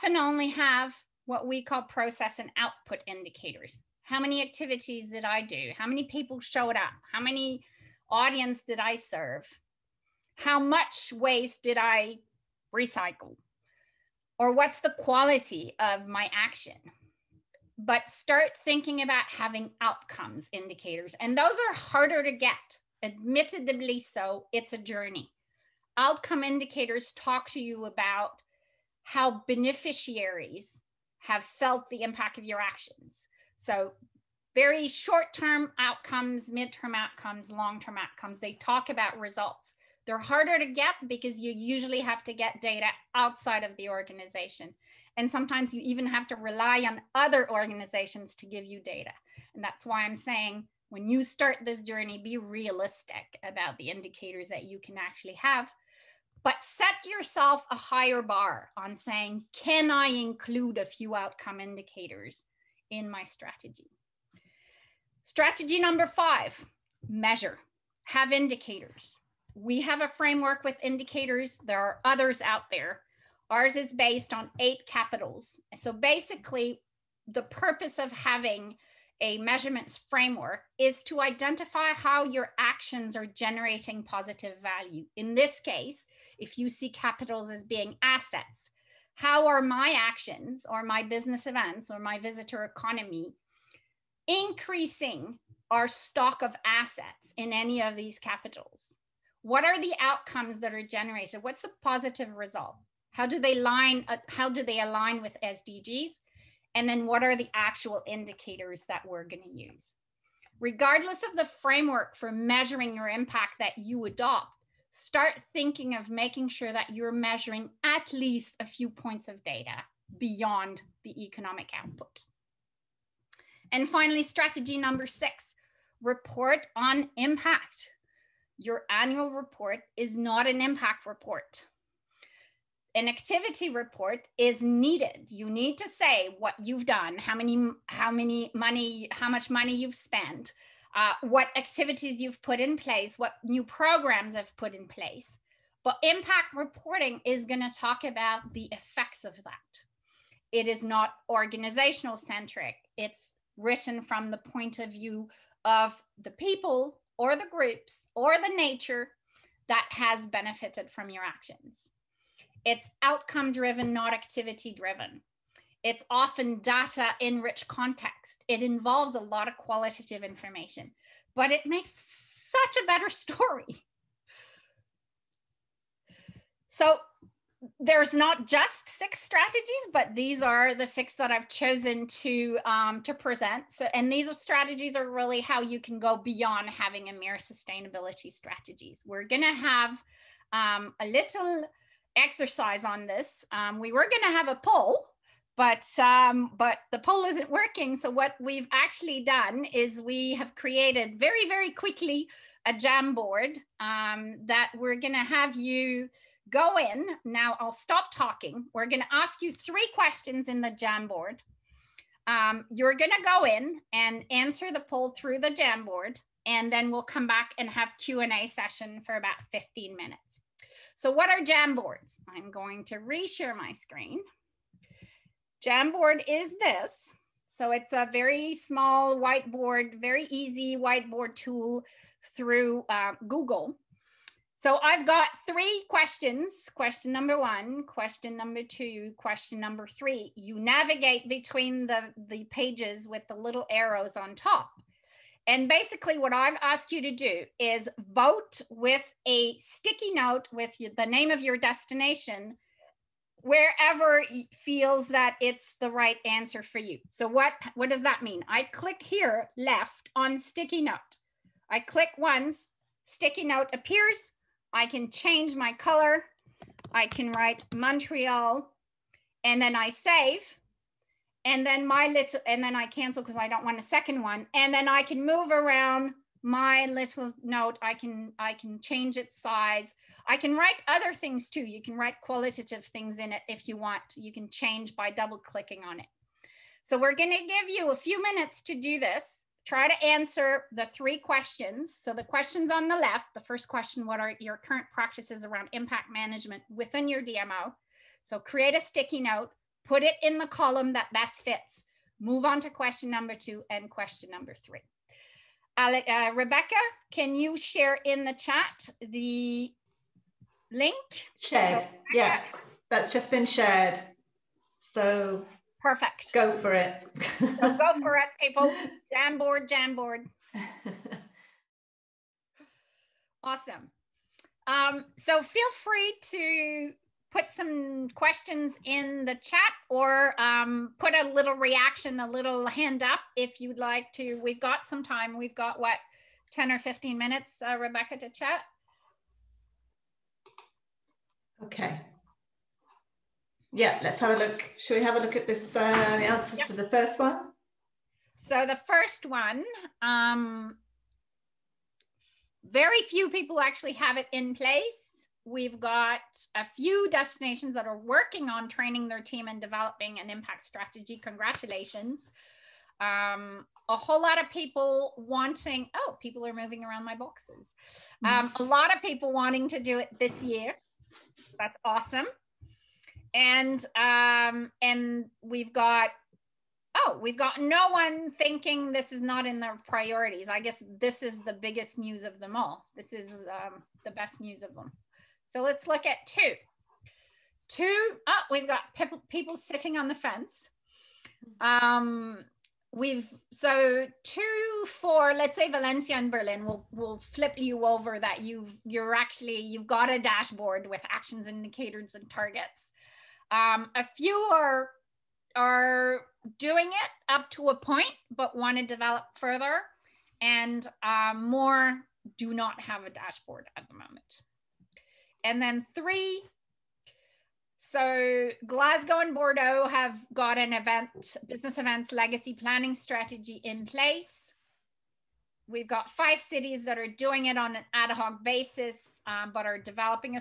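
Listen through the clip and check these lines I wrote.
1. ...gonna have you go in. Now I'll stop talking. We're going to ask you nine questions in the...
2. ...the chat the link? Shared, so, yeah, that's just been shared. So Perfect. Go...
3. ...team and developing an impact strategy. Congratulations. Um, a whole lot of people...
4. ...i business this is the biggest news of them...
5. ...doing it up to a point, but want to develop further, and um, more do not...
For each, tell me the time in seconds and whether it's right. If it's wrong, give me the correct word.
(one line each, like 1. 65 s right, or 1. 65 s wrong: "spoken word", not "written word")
1. 204 s wrong: "three", not "nine"
2. 308 s right
3. 359 s right
4. 380 s wrong: "guess", not "business"
5. 406 s right.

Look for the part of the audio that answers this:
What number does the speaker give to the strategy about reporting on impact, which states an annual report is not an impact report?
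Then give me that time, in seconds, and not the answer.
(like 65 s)
124 s.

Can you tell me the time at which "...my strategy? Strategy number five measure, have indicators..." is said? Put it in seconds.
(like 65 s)
63 s.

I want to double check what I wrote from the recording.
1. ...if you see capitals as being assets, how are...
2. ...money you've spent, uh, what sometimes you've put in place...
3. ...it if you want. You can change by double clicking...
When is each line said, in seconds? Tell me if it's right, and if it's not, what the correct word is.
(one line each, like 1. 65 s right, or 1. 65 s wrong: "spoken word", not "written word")
1. 86 s right
2. 139 s wrong: "activities", not "sometimes"
3. 283 s right.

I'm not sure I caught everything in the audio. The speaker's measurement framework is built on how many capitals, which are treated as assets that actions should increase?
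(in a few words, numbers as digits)
8.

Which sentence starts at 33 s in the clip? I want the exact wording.
So, very short term outcomes, midterm outcomes, long term outcomes.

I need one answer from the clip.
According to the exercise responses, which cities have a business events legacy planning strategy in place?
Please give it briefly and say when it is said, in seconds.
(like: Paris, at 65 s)
Glasgow and Bordeaux, at 418 s.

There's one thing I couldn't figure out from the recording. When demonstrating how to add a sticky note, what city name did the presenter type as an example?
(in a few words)
Montreal.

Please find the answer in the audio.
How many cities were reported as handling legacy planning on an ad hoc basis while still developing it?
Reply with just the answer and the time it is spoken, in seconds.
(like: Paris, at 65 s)
5, at 426 s.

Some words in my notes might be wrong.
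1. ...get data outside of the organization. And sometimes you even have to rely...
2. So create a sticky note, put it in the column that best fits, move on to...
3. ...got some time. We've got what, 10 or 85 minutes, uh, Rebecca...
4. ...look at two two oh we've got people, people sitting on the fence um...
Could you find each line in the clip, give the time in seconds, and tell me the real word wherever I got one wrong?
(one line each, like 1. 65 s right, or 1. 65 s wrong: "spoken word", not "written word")
1. 42 s right
2. 298 s right
3. 334 s wrong: "15", not "85"
4. 385 s right.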